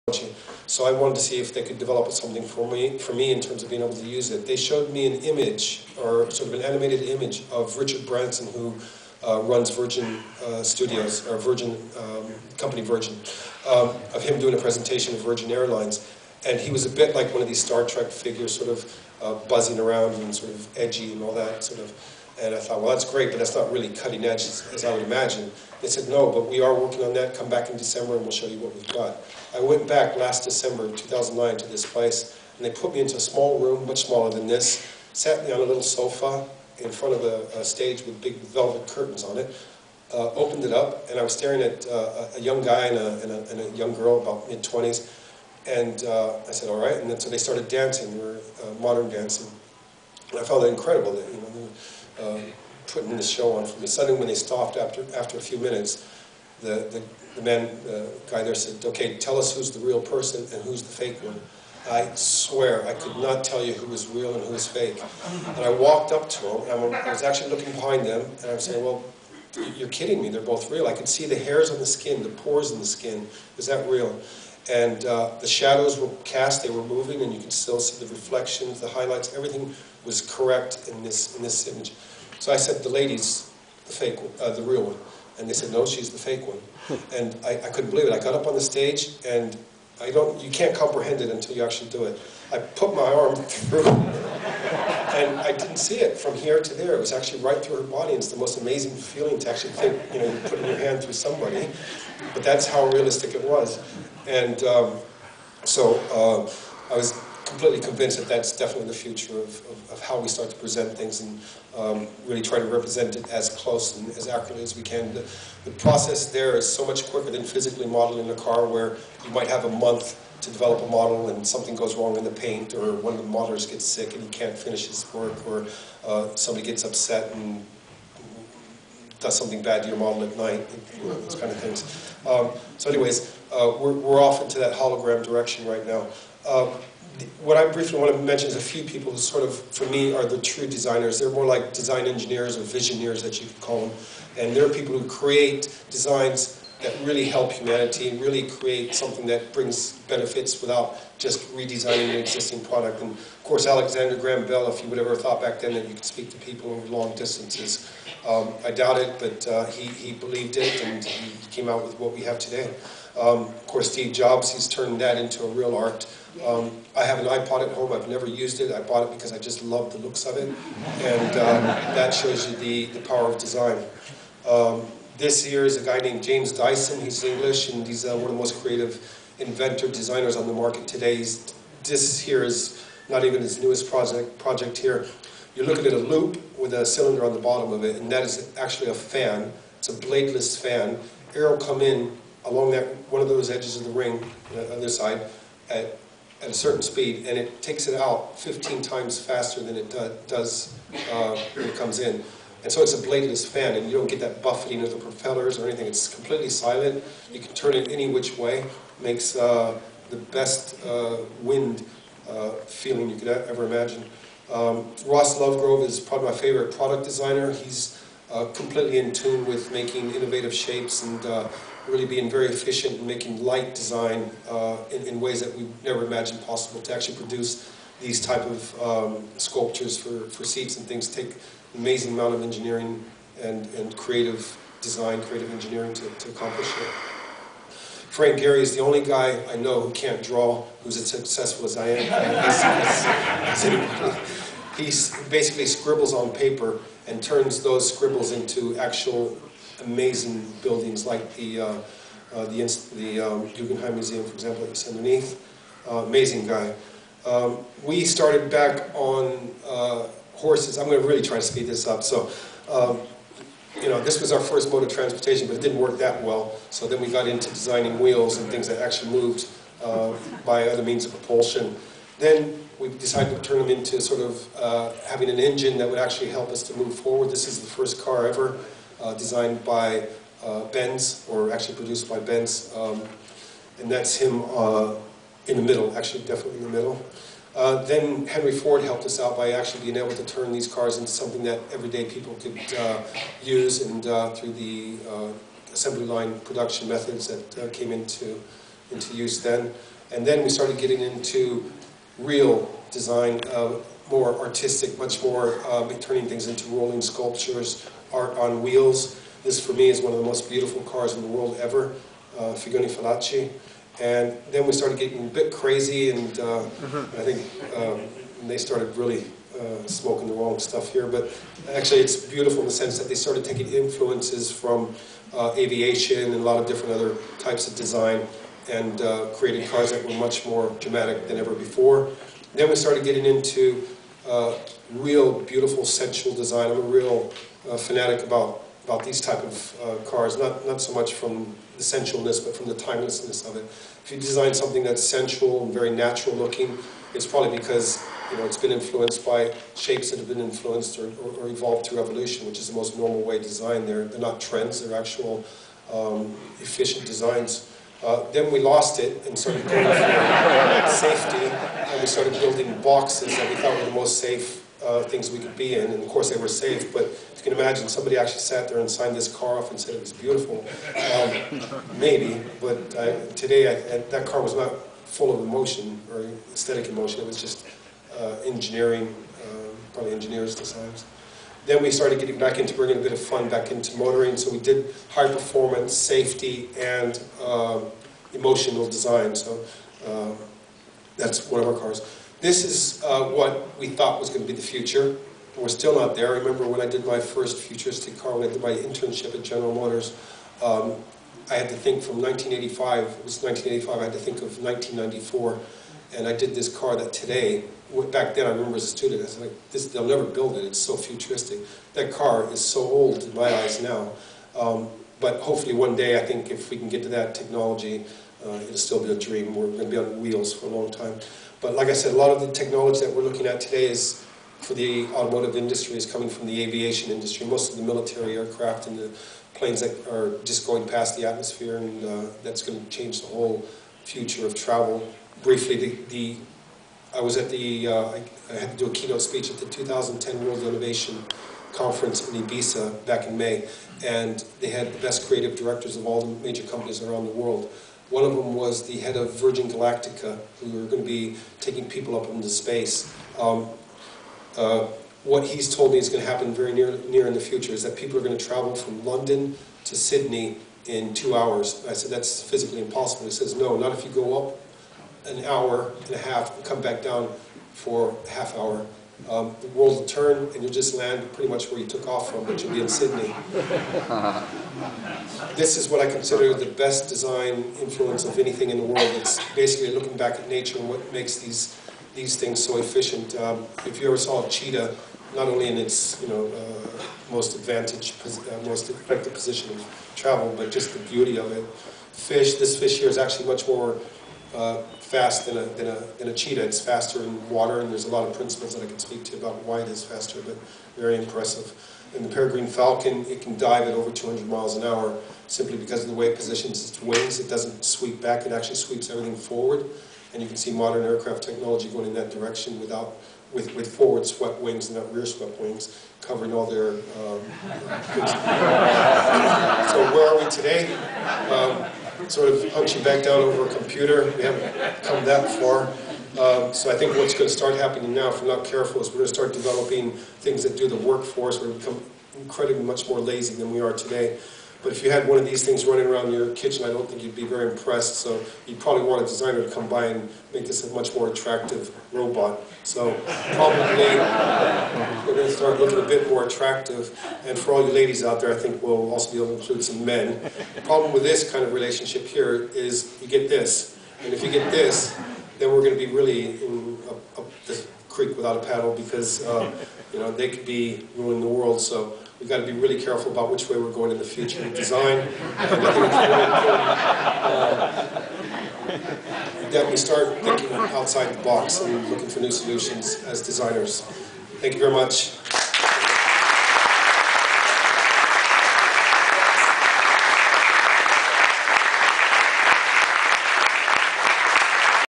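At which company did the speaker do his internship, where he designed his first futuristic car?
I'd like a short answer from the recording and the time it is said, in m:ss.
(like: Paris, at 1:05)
General Motors, at 6:39.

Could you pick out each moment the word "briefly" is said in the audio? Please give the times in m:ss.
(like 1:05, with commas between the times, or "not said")
2:17, 7:15.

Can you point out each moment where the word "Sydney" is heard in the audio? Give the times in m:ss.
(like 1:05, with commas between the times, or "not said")
7:39, 7:52.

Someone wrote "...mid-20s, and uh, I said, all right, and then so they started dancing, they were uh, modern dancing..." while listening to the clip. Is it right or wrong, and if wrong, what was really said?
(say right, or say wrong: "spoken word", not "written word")
right.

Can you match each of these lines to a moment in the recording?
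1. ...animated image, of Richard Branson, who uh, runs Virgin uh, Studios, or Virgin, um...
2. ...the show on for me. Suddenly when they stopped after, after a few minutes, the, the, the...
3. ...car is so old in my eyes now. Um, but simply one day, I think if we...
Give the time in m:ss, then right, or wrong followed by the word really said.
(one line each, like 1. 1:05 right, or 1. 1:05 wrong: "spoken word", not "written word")
1. 0:06 right
2. 0:53 right
3. 6:52 wrong: "hopefully", not "simply".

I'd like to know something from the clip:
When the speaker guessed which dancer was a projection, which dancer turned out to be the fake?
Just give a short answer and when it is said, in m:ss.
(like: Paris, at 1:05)
The lady, at 1:25.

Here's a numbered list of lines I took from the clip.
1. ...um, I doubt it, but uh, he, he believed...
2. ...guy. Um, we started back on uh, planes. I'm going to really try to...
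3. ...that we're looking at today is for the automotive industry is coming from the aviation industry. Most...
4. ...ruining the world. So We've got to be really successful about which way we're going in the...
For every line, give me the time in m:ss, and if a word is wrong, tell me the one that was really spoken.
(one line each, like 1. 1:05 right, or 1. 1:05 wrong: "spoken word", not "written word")
1. 2:38 right
2. 4:16 wrong: "horses", not "planes"
3. 7:03 right
4. 9:21 wrong: "careful", not "successful".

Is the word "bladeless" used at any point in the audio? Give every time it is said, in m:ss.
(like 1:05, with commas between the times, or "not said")
3:09, 3:23.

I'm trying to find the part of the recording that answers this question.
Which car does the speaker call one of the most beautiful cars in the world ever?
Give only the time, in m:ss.
5:12.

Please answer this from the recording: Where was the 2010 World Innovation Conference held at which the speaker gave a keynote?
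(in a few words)
Ibiza.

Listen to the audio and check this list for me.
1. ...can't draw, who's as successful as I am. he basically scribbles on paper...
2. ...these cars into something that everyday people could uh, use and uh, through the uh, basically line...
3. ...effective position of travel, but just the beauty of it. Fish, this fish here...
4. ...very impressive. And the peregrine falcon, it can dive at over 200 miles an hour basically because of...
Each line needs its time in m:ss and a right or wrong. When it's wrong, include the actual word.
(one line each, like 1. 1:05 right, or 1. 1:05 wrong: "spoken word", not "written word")
1. 3:59 right
2. 4:50 wrong: "assembly", not "basically"
3. 8:08 right
4. 8:20 wrong: "simply", not "basically".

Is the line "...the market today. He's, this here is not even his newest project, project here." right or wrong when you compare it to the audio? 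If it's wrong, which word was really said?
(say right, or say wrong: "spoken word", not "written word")
right.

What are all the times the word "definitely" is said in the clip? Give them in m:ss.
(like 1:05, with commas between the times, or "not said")
1:48, 4:46.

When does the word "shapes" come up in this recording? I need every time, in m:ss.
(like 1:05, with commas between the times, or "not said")
3:40, 5:49.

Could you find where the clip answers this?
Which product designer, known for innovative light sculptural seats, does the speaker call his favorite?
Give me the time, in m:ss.
3:35.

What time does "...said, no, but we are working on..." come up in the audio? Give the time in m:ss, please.
0:25.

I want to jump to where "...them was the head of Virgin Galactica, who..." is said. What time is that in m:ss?
7:28.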